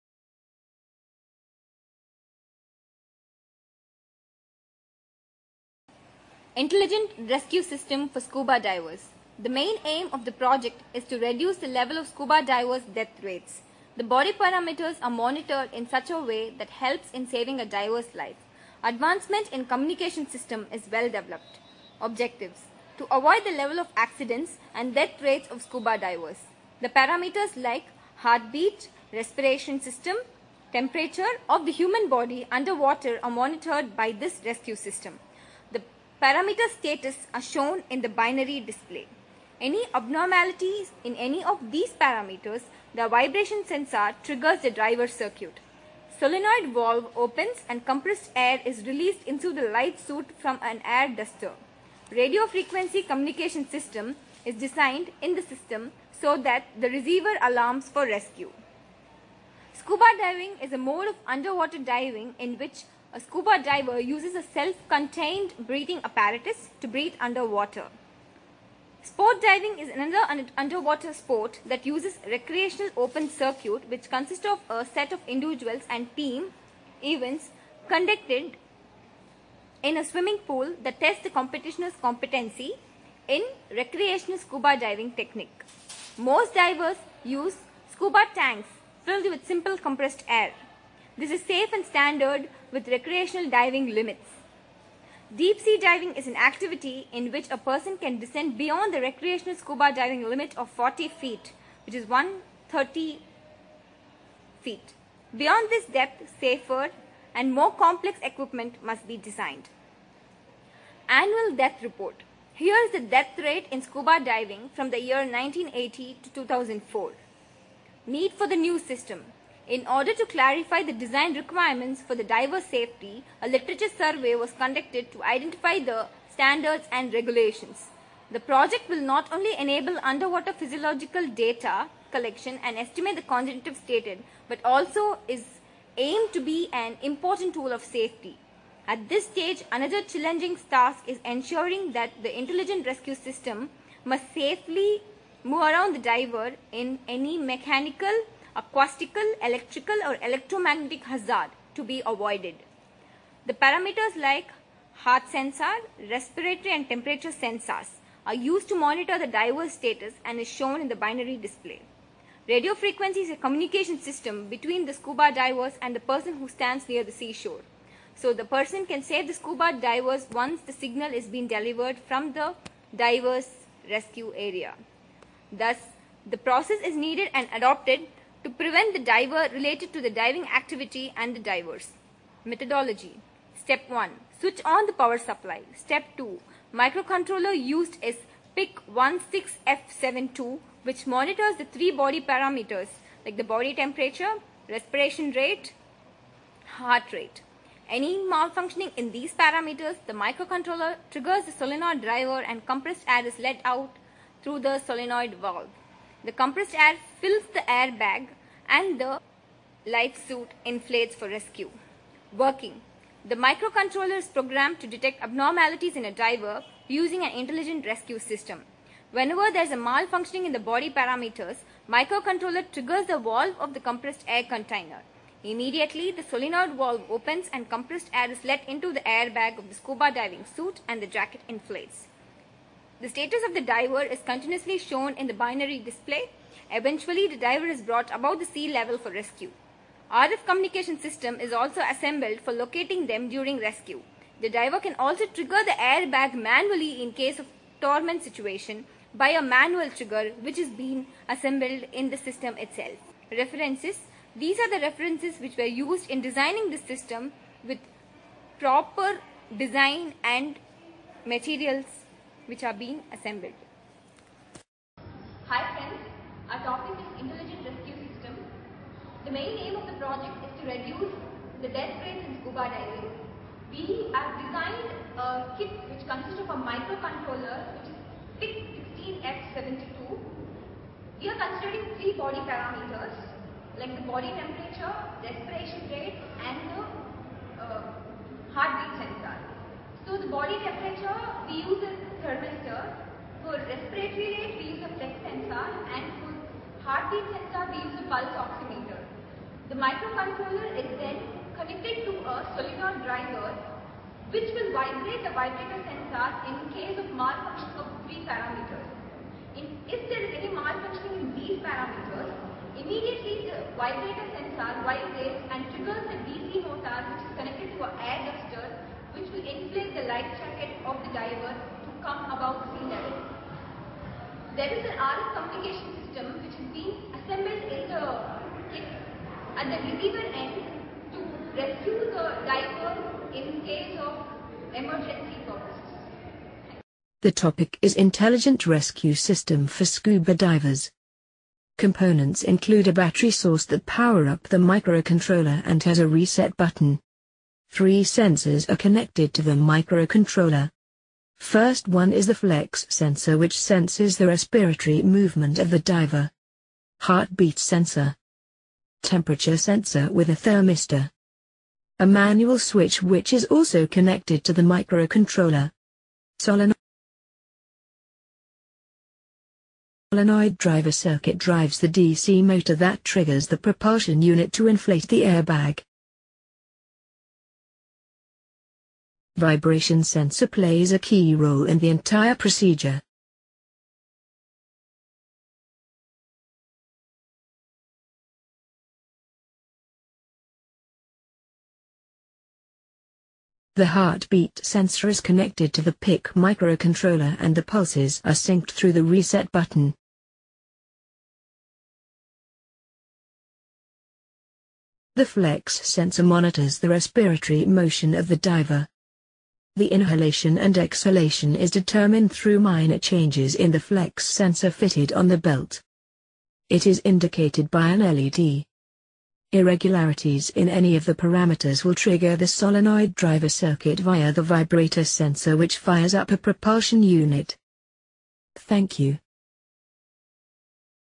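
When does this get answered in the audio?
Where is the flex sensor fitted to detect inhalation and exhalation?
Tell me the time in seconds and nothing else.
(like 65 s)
414 s.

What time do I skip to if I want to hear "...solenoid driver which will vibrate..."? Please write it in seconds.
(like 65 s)
302 s.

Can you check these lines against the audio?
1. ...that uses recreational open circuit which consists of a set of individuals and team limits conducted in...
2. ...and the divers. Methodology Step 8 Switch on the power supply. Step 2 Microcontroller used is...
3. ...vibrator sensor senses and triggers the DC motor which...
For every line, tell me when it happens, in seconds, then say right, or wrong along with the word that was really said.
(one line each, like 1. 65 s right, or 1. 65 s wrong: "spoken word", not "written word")
1. 71 s wrong: "events", not "limits"
2. 181 s wrong: "1", not "8"
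3. 313 s wrong: "vibrates", not "senses".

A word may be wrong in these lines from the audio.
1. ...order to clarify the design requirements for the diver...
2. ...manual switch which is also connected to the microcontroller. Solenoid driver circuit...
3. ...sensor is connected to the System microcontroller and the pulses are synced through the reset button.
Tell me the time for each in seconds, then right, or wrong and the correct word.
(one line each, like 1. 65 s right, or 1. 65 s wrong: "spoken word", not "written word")
1. 119 s right
2. 362 s right
3. 394 s wrong: "PIC", not "System".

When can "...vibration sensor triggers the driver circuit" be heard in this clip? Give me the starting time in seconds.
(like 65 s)
43 s.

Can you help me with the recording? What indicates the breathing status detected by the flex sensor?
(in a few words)
an LED.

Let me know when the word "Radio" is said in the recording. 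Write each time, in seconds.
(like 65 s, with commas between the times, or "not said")
52 s, 162 s.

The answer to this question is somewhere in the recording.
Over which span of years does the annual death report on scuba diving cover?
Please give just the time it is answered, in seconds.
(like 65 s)
115 s.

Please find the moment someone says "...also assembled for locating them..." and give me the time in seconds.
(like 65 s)
241 s.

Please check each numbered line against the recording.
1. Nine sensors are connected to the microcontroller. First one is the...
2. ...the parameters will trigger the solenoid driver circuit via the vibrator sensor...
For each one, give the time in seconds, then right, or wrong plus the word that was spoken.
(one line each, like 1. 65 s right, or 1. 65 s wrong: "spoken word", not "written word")
1. 347 s wrong: "Three", not "Nine"
2. 421 s right.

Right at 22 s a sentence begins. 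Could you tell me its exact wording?
Objectives To avoid the level of accidents and death rates of scuba divers.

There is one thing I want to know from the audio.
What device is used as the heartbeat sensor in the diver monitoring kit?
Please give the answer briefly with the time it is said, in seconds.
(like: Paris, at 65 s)
pulse oximeter, at 298 s.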